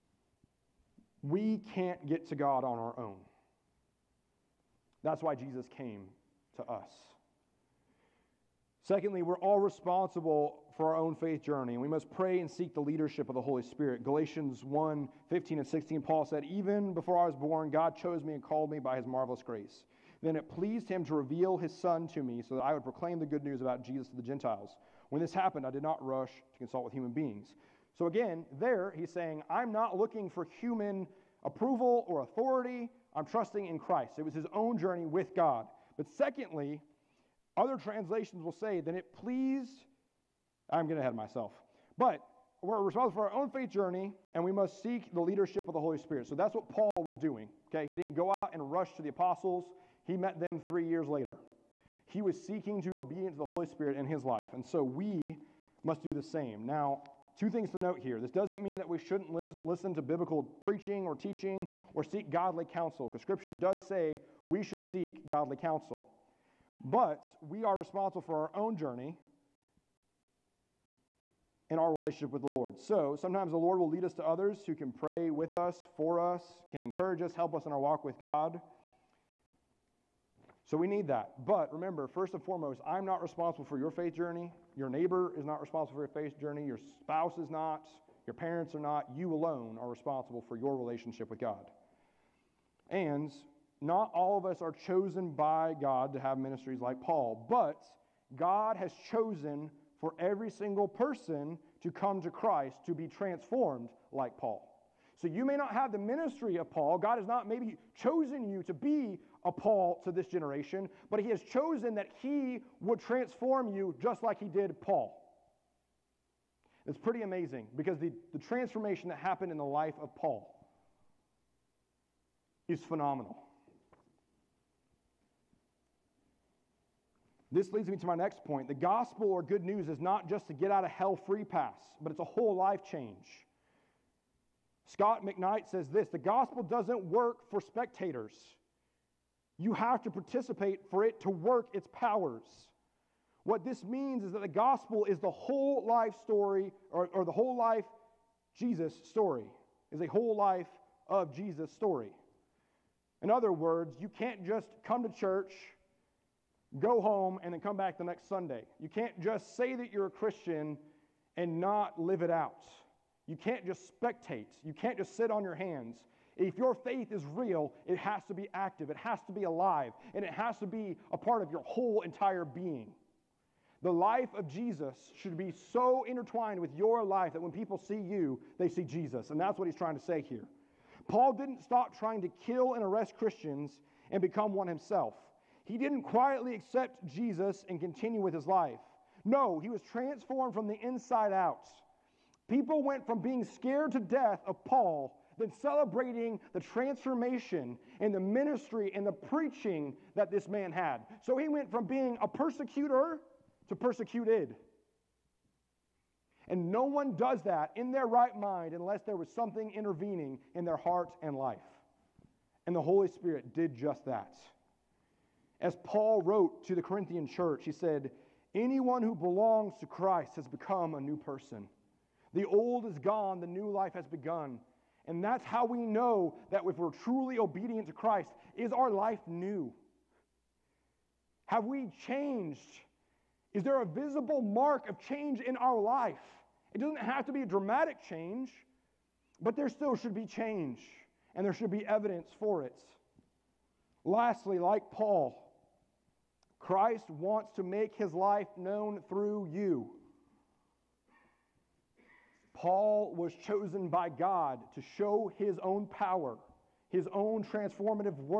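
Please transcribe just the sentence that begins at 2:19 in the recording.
You have to participate for it to work its powers.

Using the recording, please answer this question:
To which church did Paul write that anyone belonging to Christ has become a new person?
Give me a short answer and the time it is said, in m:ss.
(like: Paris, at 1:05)
Corinthian church, at 3:36.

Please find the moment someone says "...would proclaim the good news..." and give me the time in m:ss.
0:22.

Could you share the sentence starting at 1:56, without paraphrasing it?
It's pretty amazing because the, the transformation that happened in the life of Paul is phenomenal.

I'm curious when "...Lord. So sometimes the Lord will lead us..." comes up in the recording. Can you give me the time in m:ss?
1:12.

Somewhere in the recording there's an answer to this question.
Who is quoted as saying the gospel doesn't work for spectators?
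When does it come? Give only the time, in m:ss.
2:14.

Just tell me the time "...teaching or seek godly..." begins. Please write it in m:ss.
1:01.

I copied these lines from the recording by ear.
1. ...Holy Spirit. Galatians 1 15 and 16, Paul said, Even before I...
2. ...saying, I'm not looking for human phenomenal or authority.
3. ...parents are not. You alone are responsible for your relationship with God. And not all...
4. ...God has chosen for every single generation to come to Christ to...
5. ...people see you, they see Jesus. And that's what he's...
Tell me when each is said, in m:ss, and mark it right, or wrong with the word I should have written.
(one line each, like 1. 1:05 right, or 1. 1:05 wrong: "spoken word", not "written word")
1. 0:13 right
2. 0:29 wrong: "approval", not "phenomenal"
3. 1:28 right
4. 1:38 wrong: "person", not "generation"
5. 2:57 right.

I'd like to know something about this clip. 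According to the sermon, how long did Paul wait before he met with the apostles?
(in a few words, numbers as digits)
3 years.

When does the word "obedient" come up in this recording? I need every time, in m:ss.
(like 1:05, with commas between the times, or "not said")
0:52, 3:47.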